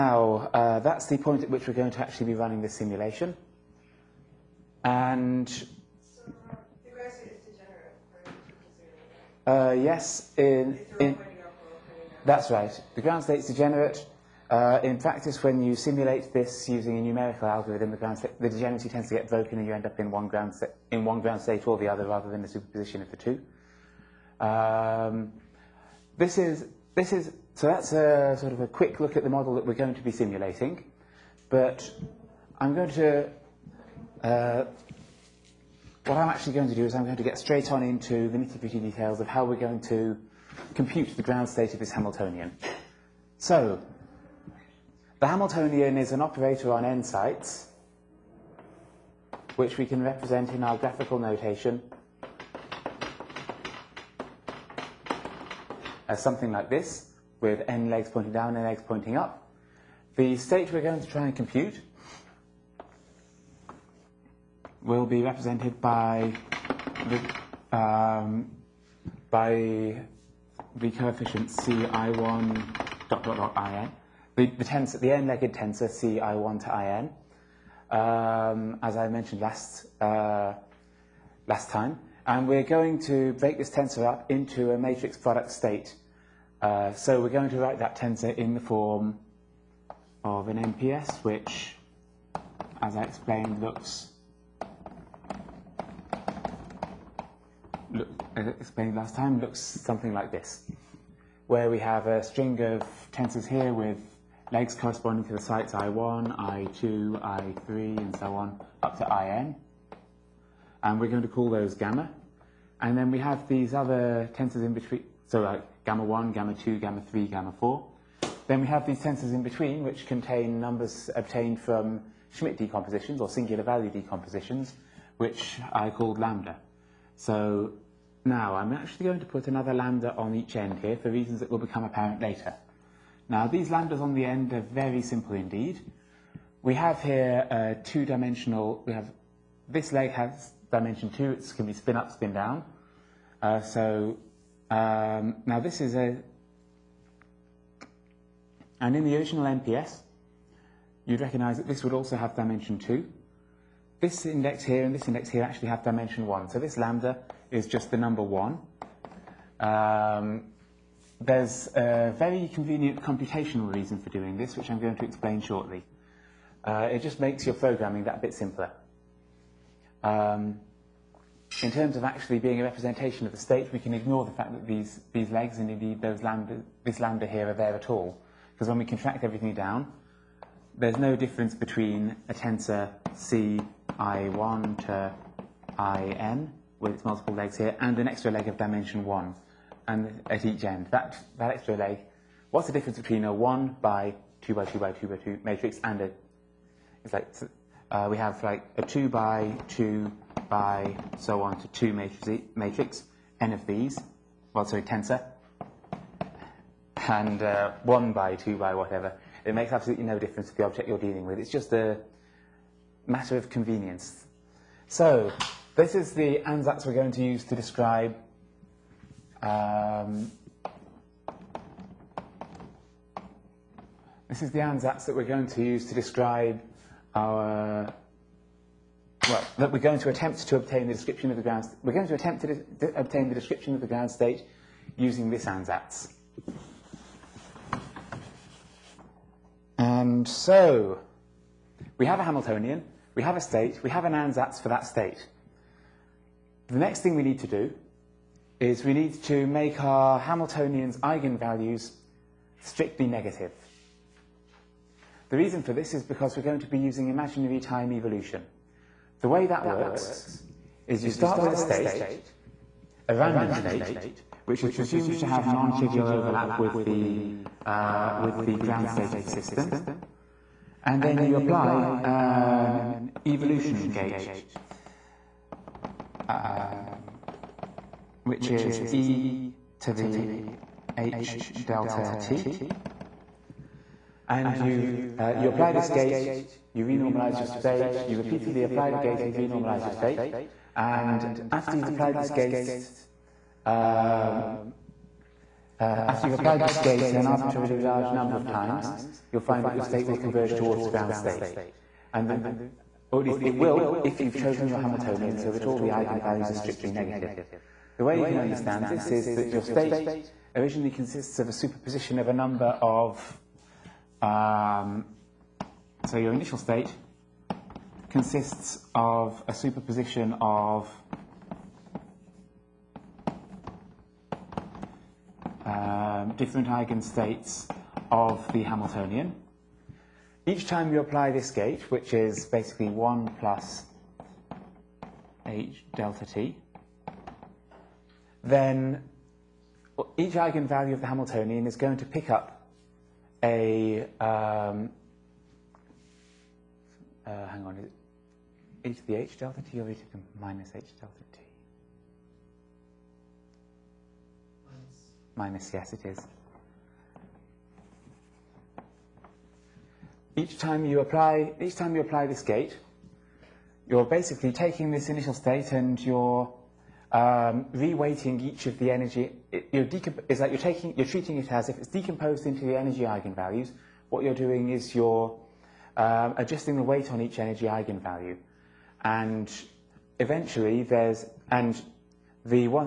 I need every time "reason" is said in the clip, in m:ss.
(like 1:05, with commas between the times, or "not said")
2:11, 2:43, 4:15.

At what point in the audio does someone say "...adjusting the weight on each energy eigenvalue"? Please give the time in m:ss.
6:16.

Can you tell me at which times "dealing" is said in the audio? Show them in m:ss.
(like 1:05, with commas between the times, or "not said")
3:30.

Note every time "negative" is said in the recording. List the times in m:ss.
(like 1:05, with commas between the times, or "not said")
4:13, 5:06.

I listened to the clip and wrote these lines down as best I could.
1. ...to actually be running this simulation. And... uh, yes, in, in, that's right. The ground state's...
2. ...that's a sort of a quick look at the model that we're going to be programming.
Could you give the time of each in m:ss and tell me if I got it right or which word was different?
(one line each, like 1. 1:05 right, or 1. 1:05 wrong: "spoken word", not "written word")
1. 0:01 right
2. 0:27 wrong: "simulating", not "programming".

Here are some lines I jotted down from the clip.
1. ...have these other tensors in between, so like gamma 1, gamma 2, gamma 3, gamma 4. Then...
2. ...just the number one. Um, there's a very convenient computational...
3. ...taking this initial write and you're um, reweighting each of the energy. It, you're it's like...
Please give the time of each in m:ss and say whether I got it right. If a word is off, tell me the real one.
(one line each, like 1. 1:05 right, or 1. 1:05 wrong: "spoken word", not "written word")
1. 1:53 right
2. 2:37 right
3. 6:04 wrong: "state", not "write".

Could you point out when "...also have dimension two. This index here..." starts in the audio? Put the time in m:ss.
2:31.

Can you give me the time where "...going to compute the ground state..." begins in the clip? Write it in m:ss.
0:39.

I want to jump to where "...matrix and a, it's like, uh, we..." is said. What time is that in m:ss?
3:15.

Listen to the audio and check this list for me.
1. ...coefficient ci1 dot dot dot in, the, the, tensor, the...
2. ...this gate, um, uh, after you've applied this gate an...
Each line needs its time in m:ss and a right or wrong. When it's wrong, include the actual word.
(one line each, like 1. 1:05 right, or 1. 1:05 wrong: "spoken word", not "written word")
1. 1:10 right
2. 4:52 right.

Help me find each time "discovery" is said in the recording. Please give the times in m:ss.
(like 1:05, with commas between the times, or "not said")
not said.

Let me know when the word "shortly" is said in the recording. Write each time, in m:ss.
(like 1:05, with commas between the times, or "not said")
2:45.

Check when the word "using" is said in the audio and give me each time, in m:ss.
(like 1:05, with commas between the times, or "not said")
0:16, 3:54, 4:16.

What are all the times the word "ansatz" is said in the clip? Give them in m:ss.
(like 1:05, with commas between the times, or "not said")
3:36, 3:44, 3:55, 4:04.